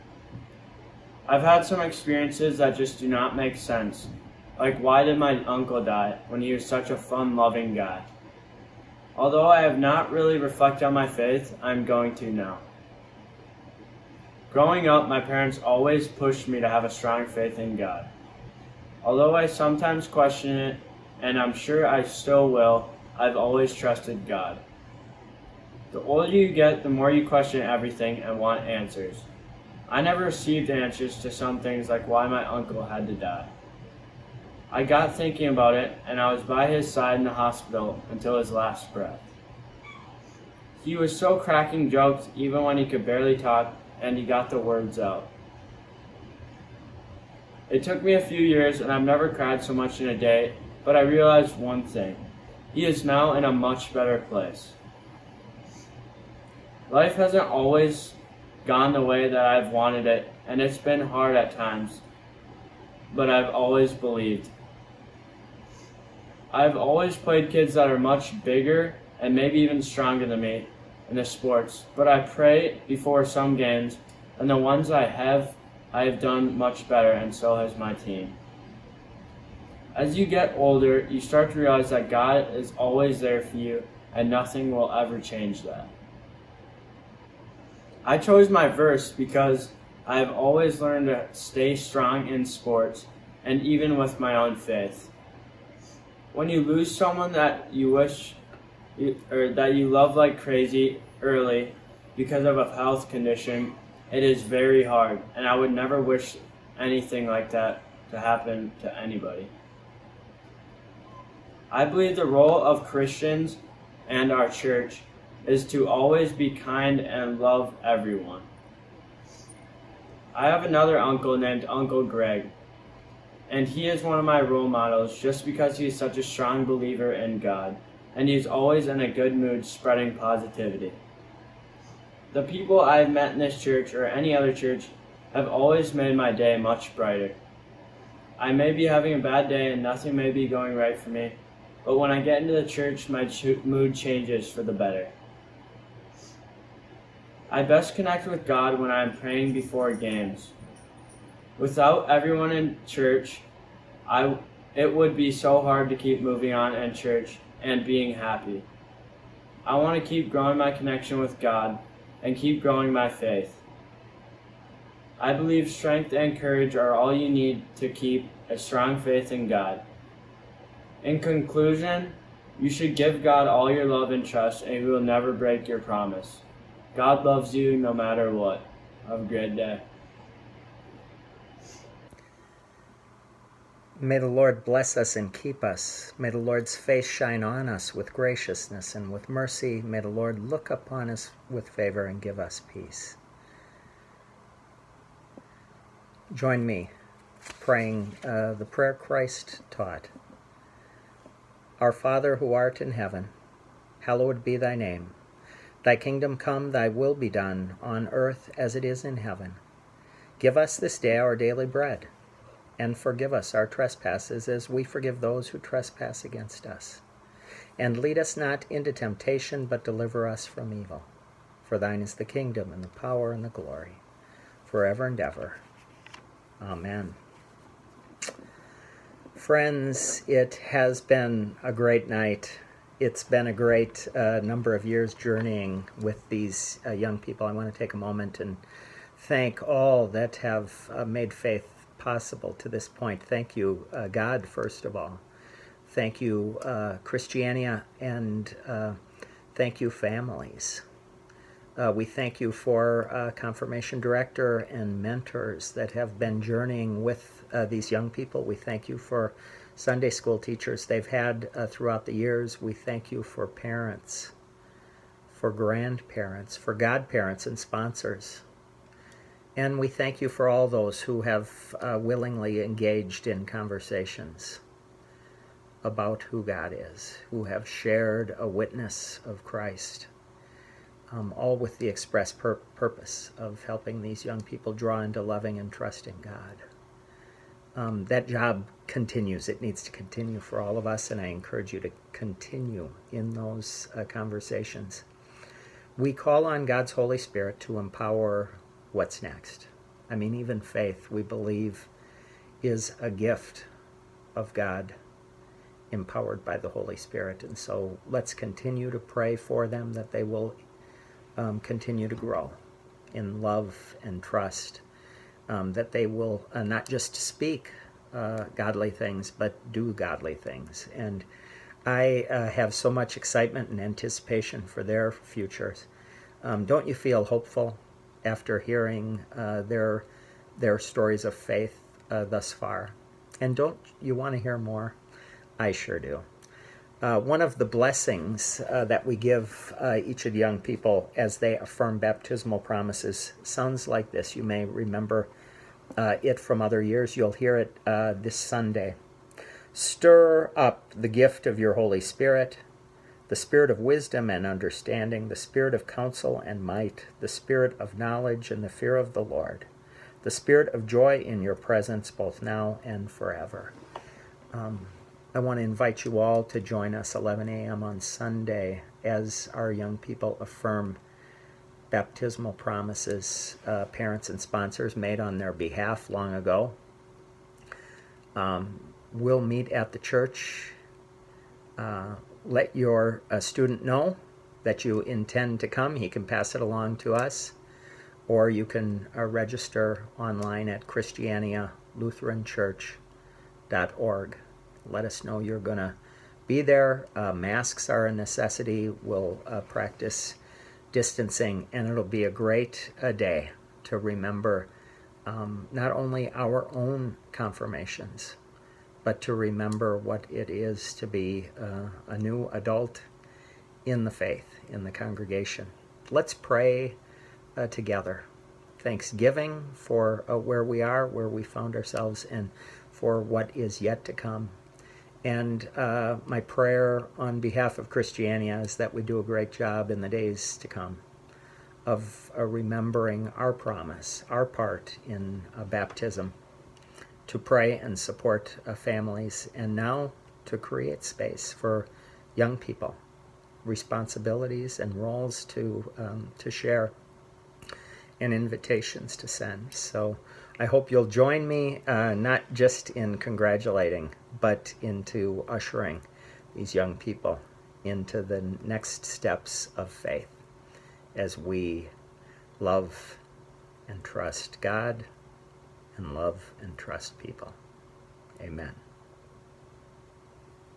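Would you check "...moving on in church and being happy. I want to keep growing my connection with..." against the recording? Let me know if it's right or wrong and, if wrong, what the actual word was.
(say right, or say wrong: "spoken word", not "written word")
right.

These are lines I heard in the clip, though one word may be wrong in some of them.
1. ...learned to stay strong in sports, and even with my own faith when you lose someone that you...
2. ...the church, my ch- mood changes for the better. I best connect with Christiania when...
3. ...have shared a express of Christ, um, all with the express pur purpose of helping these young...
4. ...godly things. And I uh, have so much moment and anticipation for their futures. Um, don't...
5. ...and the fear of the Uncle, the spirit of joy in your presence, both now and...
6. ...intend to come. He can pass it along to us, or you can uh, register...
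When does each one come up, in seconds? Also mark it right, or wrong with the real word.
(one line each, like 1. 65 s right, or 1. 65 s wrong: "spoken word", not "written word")
1. 90 s right
2. 142 s wrong: "God", not "Christiania"
3. 277 s wrong: "witness", not "express"
4. 319 s wrong: "excitement", not "moment"
5. 358 s wrong: "Lord", not "Uncle"
6. 385 s right.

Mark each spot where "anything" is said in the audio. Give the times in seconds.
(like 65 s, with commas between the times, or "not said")
106 s.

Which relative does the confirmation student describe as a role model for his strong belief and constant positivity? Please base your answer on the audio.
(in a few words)
Uncle Greg.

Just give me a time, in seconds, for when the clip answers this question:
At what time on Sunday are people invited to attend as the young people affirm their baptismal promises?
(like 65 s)
367 s.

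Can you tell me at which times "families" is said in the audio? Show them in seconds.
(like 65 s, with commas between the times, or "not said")
249 s, 438 s.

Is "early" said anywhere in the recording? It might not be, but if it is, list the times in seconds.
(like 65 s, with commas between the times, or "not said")
101 s.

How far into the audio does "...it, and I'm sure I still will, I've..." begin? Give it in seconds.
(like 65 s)
20 s.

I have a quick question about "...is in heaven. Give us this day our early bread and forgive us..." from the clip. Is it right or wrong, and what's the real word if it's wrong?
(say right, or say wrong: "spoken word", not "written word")
wrong: "daily", not "early".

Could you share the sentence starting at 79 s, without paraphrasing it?
As you get older, you start to realize that God is always there for you, and nothing will ever change that.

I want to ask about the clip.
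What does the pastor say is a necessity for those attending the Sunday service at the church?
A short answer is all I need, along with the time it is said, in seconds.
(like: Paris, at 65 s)
Masks, at 397 s.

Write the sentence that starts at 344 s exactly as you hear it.
You may remember uh, it from other years.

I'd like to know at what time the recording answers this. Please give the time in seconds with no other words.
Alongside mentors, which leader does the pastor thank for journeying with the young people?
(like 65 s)
253 s.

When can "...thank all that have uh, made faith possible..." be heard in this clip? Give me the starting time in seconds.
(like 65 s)
239 s.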